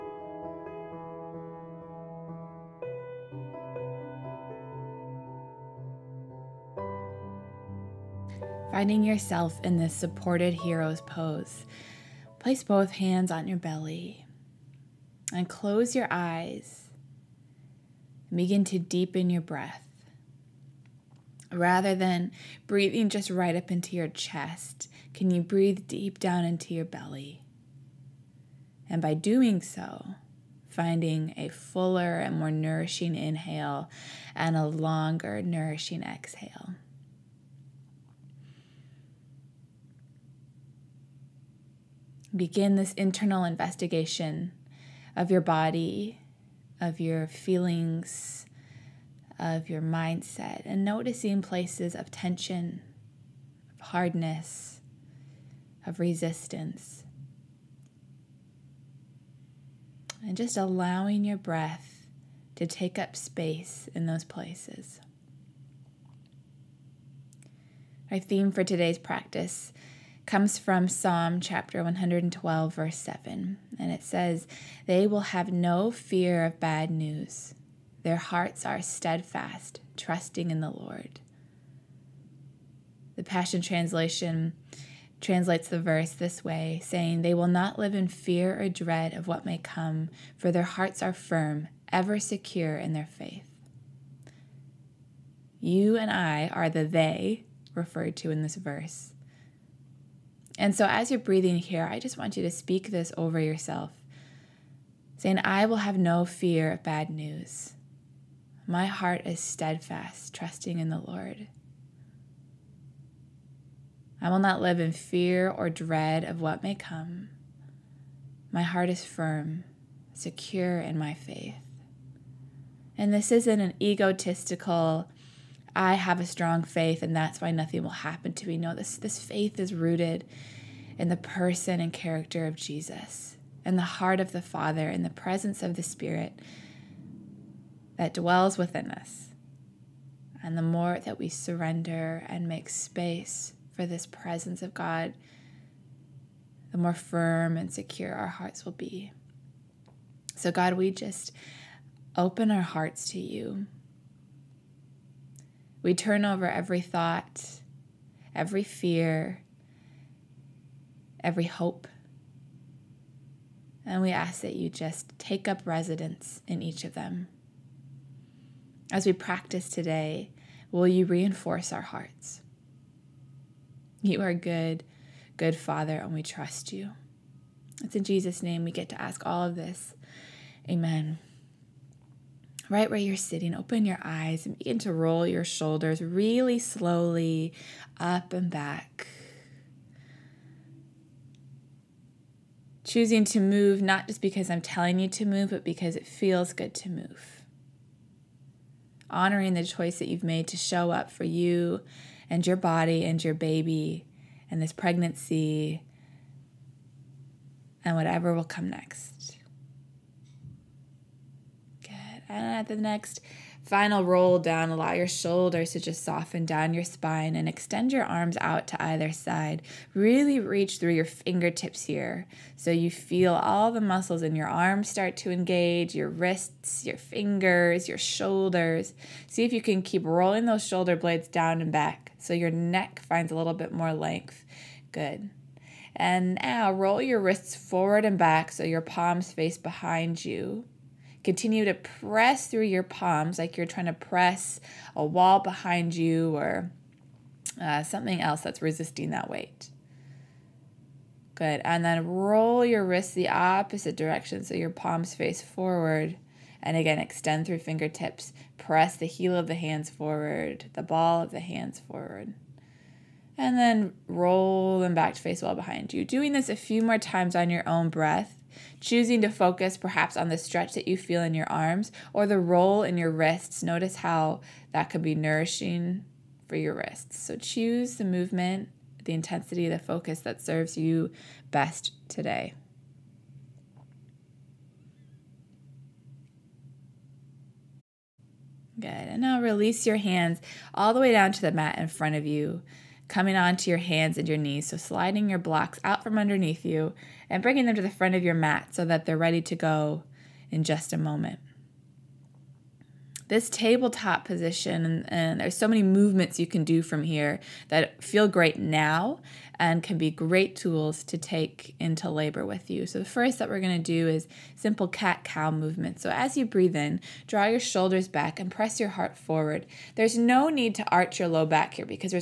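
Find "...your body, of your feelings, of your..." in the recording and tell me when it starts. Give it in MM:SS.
00:45.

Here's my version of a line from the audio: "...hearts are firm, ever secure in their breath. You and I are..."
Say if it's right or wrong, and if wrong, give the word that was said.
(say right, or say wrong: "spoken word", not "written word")
wrong: "faith", not "breath".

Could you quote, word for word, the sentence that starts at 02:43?
And we ask that you just take up residence in each of them.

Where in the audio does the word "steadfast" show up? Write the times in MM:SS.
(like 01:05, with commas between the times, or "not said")
01:18, 01:49.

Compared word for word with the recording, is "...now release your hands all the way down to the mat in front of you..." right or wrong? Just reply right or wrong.
right.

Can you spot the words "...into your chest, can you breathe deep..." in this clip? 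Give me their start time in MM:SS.
00:23.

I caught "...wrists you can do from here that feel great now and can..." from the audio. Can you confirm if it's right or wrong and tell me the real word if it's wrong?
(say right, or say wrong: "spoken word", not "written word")
wrong: "movements", not "wrists".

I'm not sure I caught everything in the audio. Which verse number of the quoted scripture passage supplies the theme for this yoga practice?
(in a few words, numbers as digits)
7.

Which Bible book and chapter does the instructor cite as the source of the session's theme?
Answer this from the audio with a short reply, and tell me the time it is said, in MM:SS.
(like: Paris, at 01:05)
Psalm 112, at 01:10.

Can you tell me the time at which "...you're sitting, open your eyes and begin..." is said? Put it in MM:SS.
03:02.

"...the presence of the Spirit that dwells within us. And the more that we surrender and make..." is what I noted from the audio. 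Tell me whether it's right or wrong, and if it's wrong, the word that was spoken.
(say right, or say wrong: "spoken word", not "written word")
right.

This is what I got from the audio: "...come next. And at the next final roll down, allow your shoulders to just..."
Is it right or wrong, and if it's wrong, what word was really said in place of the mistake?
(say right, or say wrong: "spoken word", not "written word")
right.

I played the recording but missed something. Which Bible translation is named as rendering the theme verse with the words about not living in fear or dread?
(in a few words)
The Passion Translation.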